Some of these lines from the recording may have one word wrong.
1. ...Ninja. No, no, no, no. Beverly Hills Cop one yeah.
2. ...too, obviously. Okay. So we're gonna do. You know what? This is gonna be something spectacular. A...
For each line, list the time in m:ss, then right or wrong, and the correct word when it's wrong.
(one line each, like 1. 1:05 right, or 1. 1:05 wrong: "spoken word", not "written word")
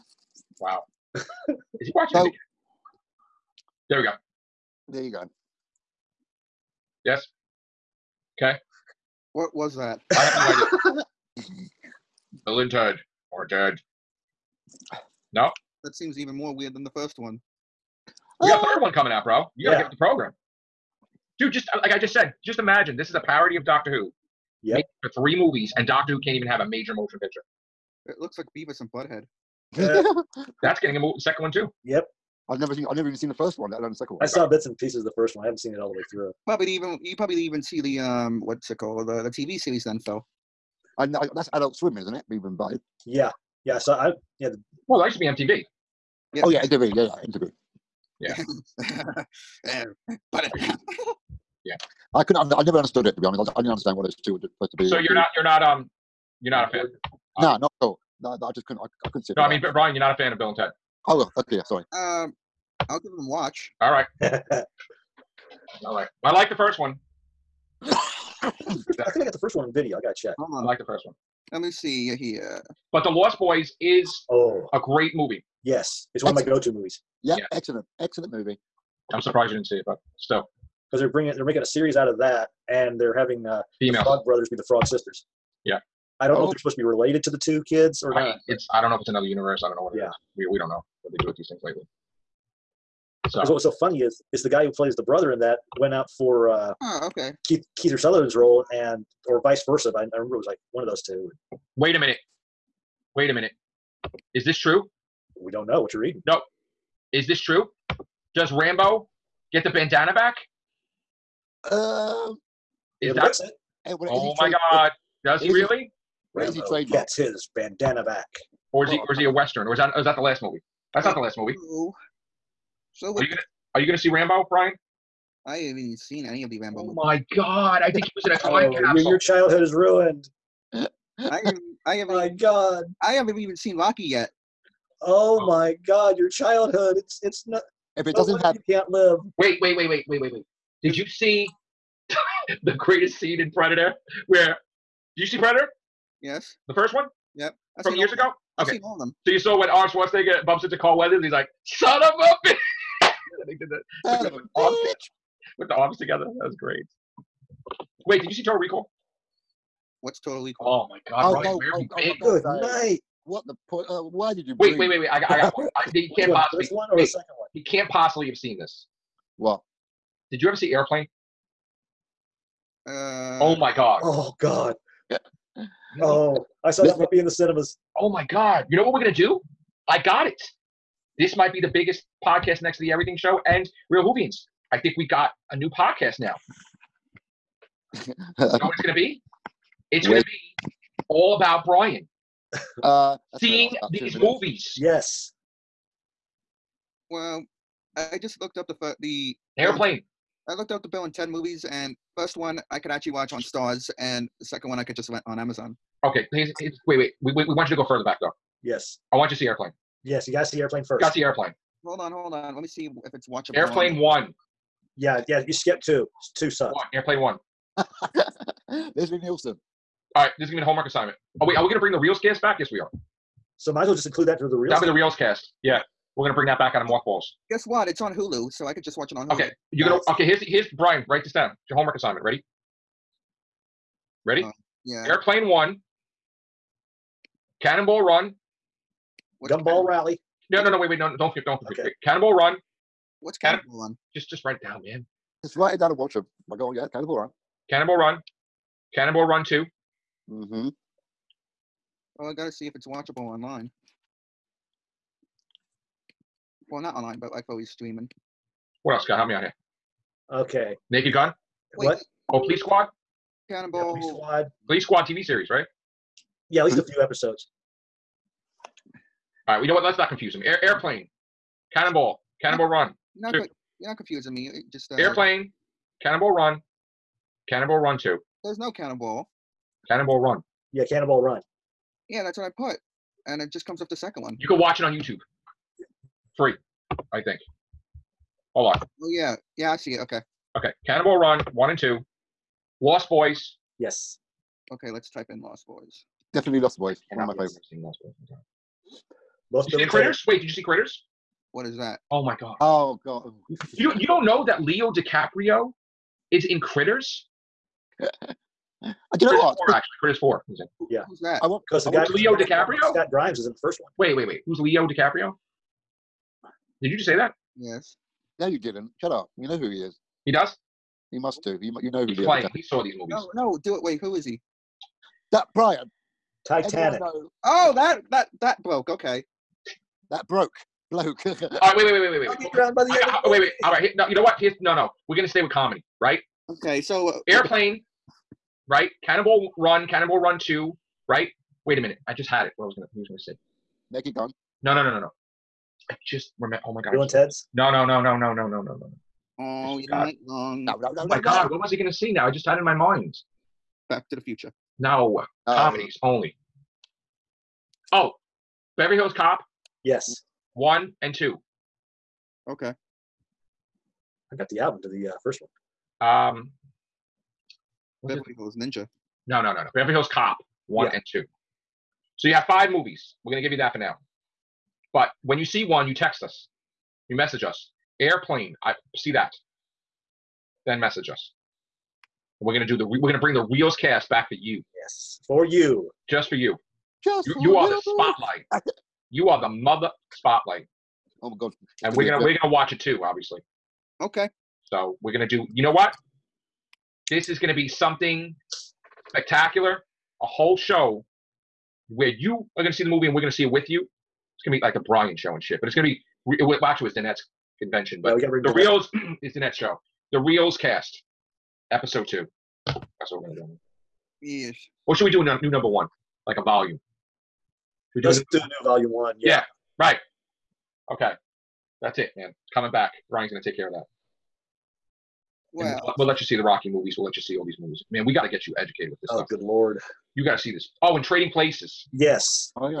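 1. 6:08 right
2. 6:32 right.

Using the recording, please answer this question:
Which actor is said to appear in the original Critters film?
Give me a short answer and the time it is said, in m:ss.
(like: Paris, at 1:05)
Scott Grimes, at 5:12.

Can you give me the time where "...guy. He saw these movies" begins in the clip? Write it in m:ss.
5:22.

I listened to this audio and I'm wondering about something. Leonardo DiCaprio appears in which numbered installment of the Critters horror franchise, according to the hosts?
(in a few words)
Critters 4.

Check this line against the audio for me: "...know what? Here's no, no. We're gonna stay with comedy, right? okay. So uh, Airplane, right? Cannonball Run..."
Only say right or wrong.
right.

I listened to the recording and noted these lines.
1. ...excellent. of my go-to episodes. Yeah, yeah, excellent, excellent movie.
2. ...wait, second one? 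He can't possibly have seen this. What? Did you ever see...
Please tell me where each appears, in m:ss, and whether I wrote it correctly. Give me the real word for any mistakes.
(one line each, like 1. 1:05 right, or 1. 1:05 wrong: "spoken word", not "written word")
1. 1:16 wrong: "movies", not "episodes"
2. 2:46 right.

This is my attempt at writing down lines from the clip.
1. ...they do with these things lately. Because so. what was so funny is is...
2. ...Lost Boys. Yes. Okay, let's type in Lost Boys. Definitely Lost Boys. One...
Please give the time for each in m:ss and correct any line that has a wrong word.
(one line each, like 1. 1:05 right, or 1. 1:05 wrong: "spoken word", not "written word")
1. 1:31 right
2. 4:52 right.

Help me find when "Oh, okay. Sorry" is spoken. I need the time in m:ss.
1:01.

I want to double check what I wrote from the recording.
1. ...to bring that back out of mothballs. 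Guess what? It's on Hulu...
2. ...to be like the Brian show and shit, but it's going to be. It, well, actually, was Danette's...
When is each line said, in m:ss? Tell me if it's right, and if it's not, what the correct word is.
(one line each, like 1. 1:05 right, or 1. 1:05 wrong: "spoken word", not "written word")
1. 3:46 right
2. 6:44 right.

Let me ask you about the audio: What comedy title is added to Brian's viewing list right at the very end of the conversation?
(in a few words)
Trading Places.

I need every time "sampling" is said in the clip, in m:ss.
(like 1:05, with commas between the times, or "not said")
not said.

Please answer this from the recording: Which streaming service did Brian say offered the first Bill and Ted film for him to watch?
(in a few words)
Starz.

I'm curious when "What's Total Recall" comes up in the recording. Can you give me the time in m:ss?
2:40.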